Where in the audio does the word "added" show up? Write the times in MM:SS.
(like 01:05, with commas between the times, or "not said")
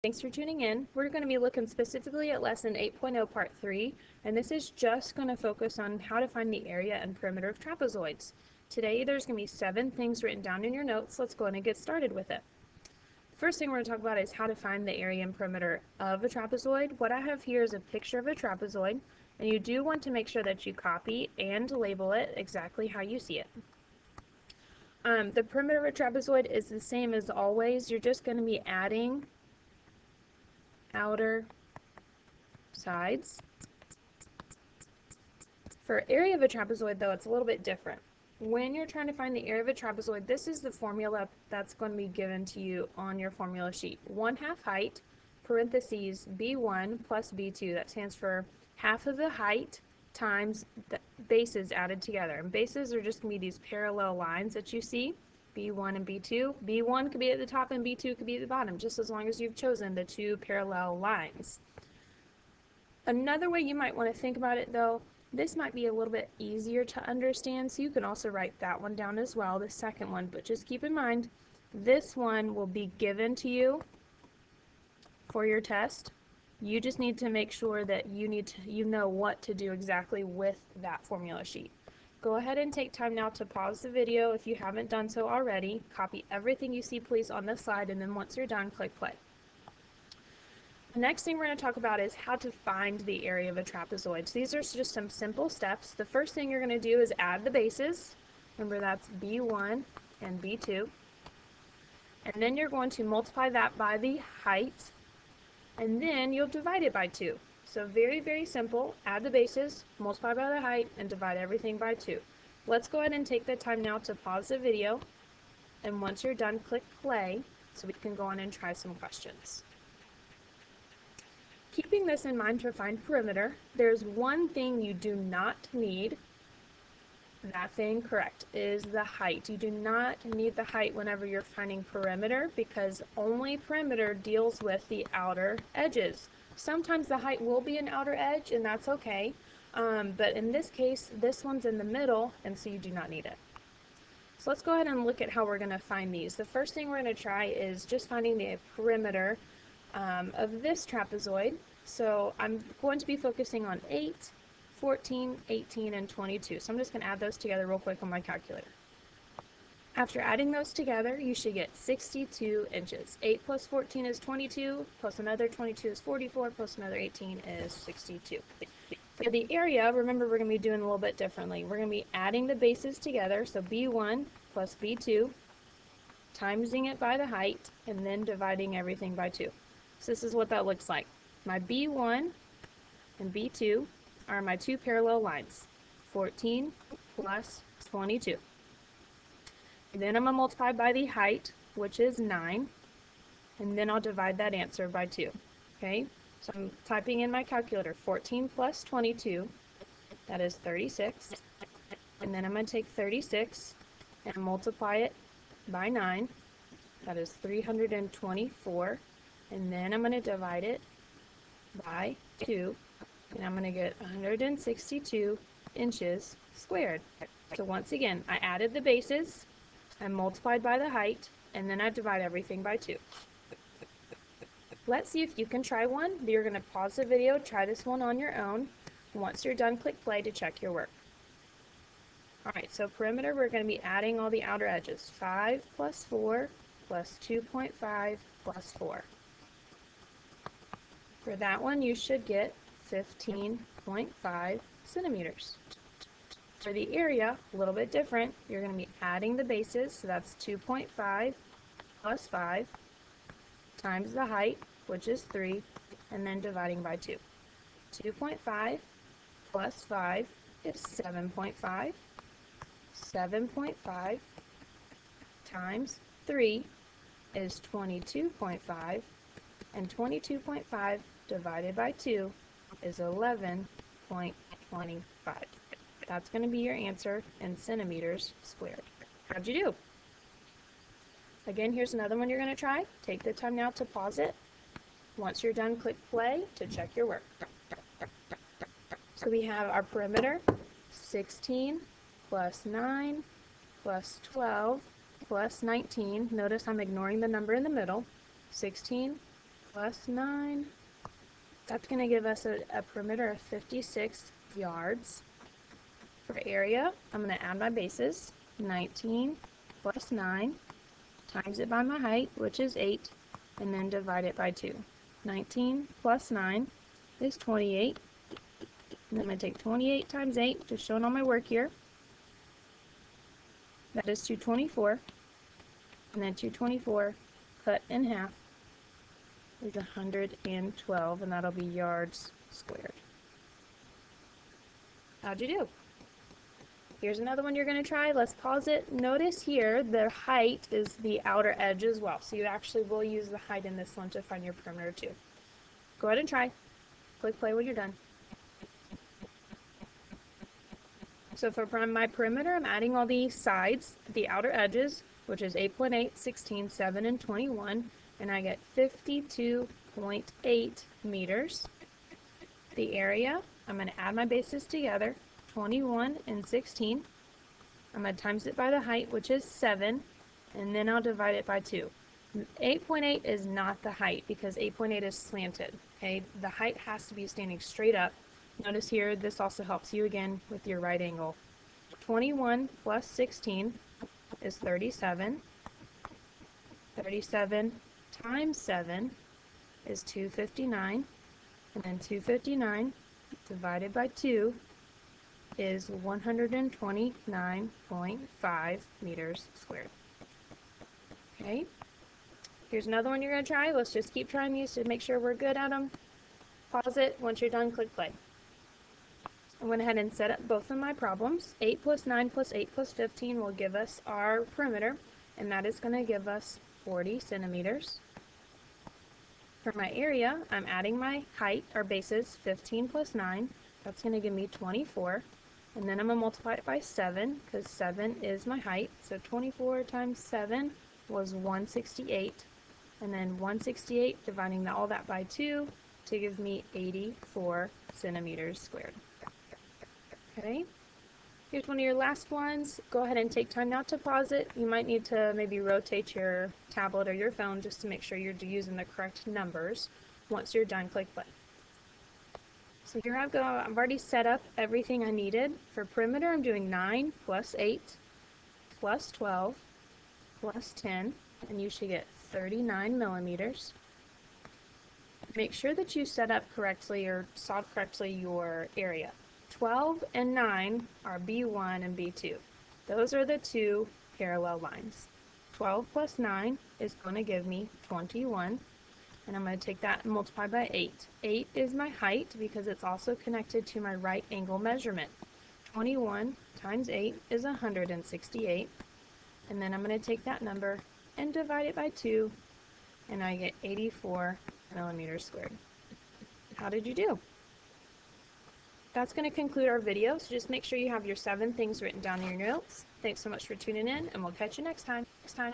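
00:51, 03:38.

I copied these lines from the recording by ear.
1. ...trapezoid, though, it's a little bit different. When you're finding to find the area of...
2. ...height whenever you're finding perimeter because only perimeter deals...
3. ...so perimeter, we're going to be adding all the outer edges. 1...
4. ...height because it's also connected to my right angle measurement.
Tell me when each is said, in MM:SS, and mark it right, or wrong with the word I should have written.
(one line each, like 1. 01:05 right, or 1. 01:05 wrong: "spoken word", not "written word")
1. 00:36 wrong: "trying", not "finding"
2. 02:10 right
3. 03:52 wrong: "5", not "1"
4. 08:01 right.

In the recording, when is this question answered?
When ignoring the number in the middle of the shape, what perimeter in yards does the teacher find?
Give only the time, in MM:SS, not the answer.
05:03.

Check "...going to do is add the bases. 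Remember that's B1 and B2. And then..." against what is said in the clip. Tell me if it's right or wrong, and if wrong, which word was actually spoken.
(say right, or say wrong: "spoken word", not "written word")
right.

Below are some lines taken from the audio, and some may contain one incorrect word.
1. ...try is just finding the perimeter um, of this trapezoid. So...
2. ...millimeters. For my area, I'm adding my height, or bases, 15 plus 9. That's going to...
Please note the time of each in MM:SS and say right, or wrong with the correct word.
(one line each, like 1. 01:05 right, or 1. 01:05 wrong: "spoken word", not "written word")
1. 02:27 right
2. 06:57 wrong: "centimeters", not "millimeters".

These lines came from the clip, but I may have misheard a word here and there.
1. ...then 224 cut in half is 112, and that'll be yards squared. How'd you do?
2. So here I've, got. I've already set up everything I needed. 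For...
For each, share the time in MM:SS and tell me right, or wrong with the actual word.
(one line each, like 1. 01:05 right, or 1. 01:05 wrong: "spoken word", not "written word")
1. 05:26 right
2. 07:32 right.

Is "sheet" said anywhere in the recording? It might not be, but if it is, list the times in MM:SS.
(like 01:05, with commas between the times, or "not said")
00:43, 01:21.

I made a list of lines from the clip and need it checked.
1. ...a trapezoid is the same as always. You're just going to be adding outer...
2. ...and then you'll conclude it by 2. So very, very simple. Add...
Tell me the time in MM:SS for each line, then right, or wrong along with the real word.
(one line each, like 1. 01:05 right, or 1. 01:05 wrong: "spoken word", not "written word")
1. 00:25 right
2. 01:45 wrong: "divide", not "conclude".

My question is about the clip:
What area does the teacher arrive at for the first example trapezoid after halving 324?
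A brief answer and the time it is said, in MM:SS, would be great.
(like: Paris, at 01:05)
162 inches squared, at 03:34.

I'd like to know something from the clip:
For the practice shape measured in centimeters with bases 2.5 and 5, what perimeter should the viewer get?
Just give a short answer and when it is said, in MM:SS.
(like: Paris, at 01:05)
15.5 centimeters, at 04:02.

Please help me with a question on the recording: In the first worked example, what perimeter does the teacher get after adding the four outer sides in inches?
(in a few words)
62 inches.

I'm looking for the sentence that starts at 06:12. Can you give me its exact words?
8.8 is not the height because 8.8 is slanted.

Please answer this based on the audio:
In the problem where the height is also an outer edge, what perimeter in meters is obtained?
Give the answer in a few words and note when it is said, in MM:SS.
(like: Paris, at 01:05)
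52.8 meters, at 05:58.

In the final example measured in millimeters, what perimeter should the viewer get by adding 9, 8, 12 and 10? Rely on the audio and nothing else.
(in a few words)
39 millimeters.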